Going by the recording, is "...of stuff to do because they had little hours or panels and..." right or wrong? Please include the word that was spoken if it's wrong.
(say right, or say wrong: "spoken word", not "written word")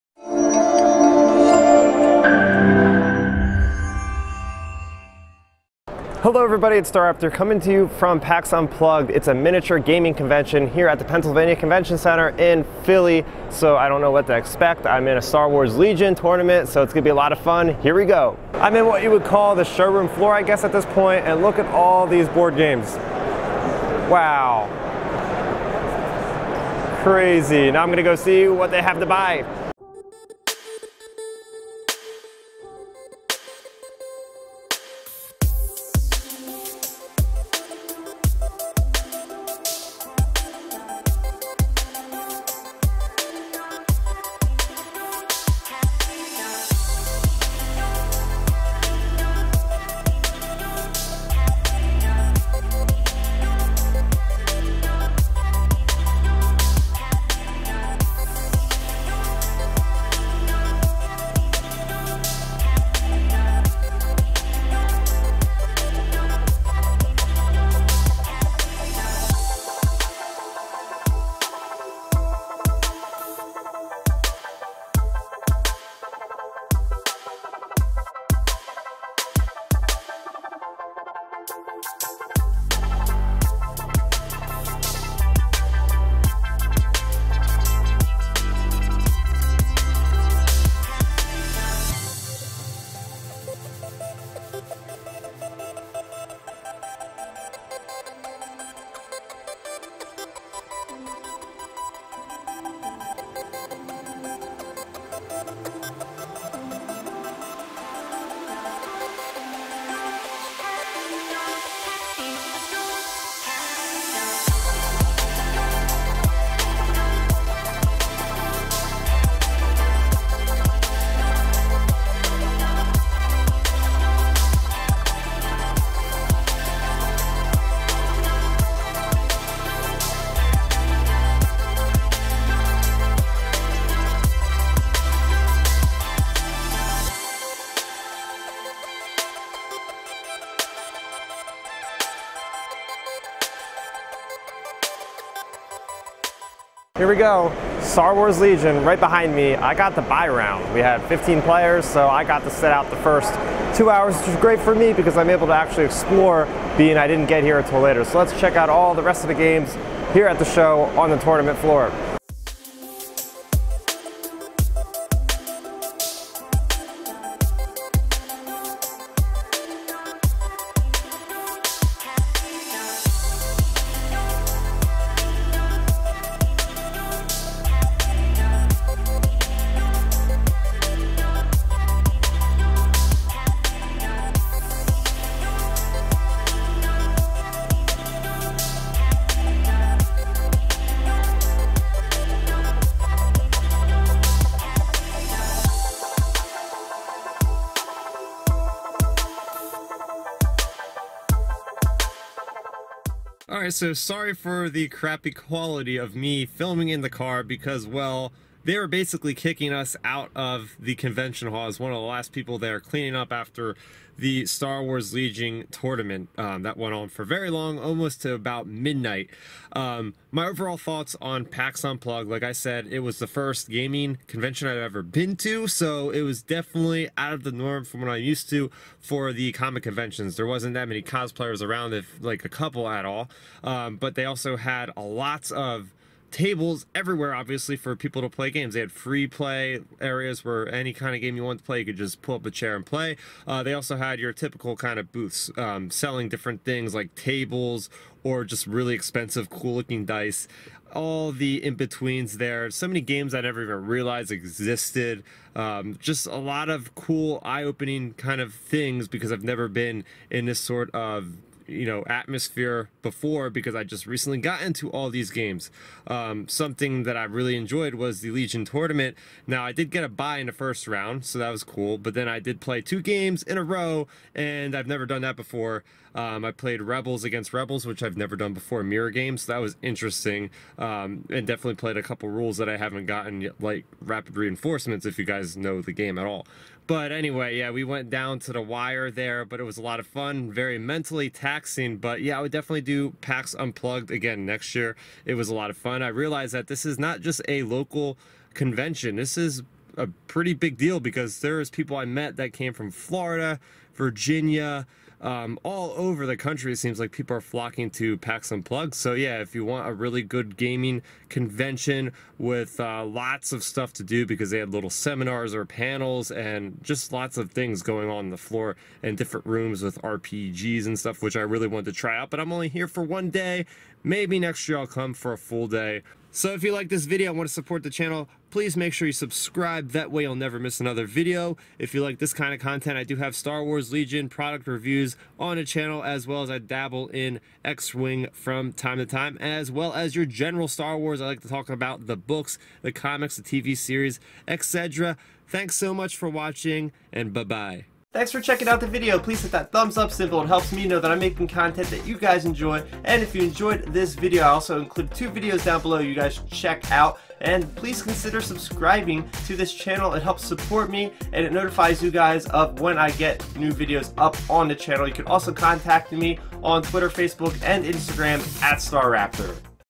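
wrong: "seminars", not "hours".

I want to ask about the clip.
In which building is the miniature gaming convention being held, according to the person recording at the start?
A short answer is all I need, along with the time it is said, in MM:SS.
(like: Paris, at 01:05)
Pennsylvania Convention Center, at 00:11.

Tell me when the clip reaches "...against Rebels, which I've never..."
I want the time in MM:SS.
04:37.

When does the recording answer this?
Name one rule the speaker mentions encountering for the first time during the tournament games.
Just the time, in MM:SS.
04:44.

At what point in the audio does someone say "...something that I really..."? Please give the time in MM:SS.
04:26.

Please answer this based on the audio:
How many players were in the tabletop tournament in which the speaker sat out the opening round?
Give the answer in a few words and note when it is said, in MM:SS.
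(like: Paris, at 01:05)
15, at 02:31.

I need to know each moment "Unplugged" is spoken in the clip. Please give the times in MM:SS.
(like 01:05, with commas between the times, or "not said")
00:08, 03:41, 04:53, 05:08.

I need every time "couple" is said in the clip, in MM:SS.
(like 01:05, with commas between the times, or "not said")
03:52, 04:42.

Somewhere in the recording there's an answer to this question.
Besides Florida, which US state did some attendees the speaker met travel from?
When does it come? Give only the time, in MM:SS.
05:03.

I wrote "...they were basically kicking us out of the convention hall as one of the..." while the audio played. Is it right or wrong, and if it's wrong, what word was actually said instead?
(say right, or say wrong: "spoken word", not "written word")
right.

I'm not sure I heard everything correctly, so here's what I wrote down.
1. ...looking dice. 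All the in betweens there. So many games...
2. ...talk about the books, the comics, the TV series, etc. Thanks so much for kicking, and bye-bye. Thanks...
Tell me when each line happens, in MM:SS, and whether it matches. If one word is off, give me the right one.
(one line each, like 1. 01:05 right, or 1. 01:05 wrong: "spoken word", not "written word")
1. 04:09 right
2. 05:41 wrong: "watching", not "kicking".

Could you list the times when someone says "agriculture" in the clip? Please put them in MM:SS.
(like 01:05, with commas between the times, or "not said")
not said.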